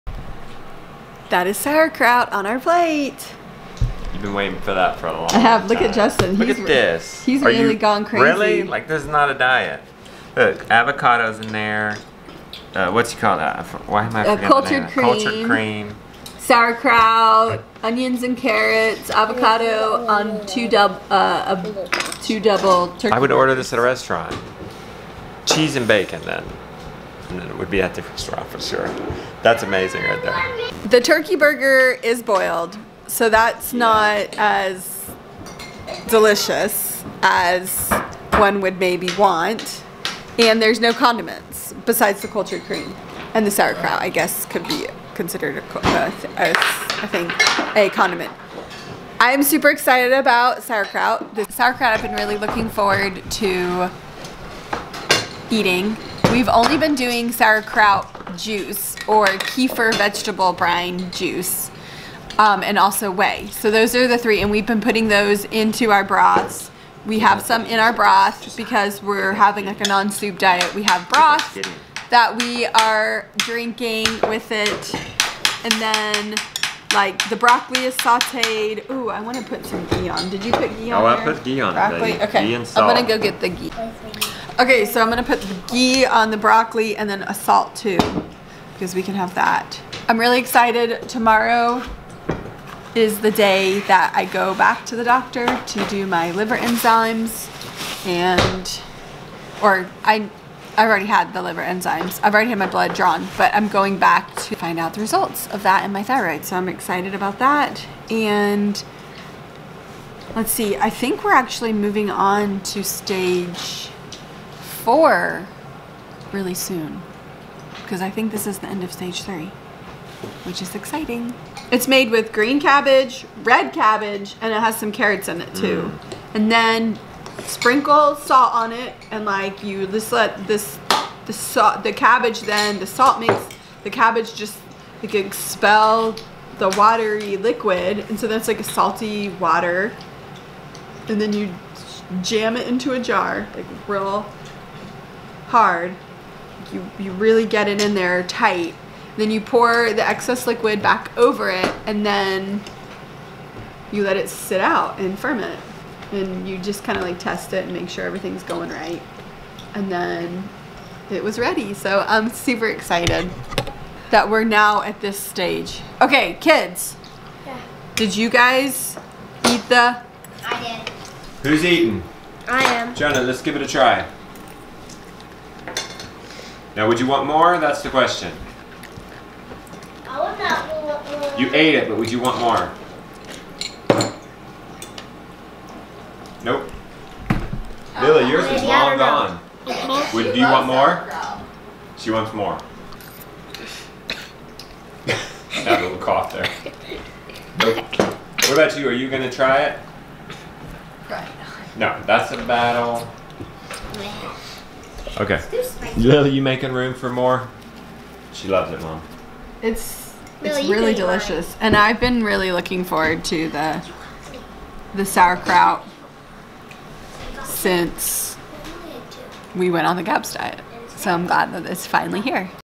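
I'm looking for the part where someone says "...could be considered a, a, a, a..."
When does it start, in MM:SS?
00:44.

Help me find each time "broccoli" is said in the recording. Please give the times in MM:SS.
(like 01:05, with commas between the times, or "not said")
01:17, 01:21, 01:26.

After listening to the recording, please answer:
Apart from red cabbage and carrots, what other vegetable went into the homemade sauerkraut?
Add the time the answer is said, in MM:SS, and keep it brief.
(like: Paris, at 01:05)
Green cabbage, at 02:02.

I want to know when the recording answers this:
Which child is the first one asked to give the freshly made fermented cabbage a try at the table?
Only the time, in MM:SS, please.
02:52.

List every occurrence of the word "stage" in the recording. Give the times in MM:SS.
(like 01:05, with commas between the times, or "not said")
01:52, 01:58, 02:45.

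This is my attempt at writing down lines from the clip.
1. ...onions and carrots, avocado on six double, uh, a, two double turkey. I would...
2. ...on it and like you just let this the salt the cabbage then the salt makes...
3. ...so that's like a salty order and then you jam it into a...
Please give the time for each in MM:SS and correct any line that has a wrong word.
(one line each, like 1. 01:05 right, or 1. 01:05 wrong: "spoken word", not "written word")
1. 00:17 wrong: "two", not "six"
2. 02:08 right
3. 02:18 wrong: "water", not "order".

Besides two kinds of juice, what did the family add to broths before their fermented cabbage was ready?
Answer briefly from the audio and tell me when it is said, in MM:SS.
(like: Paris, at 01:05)
whey, at 01:03.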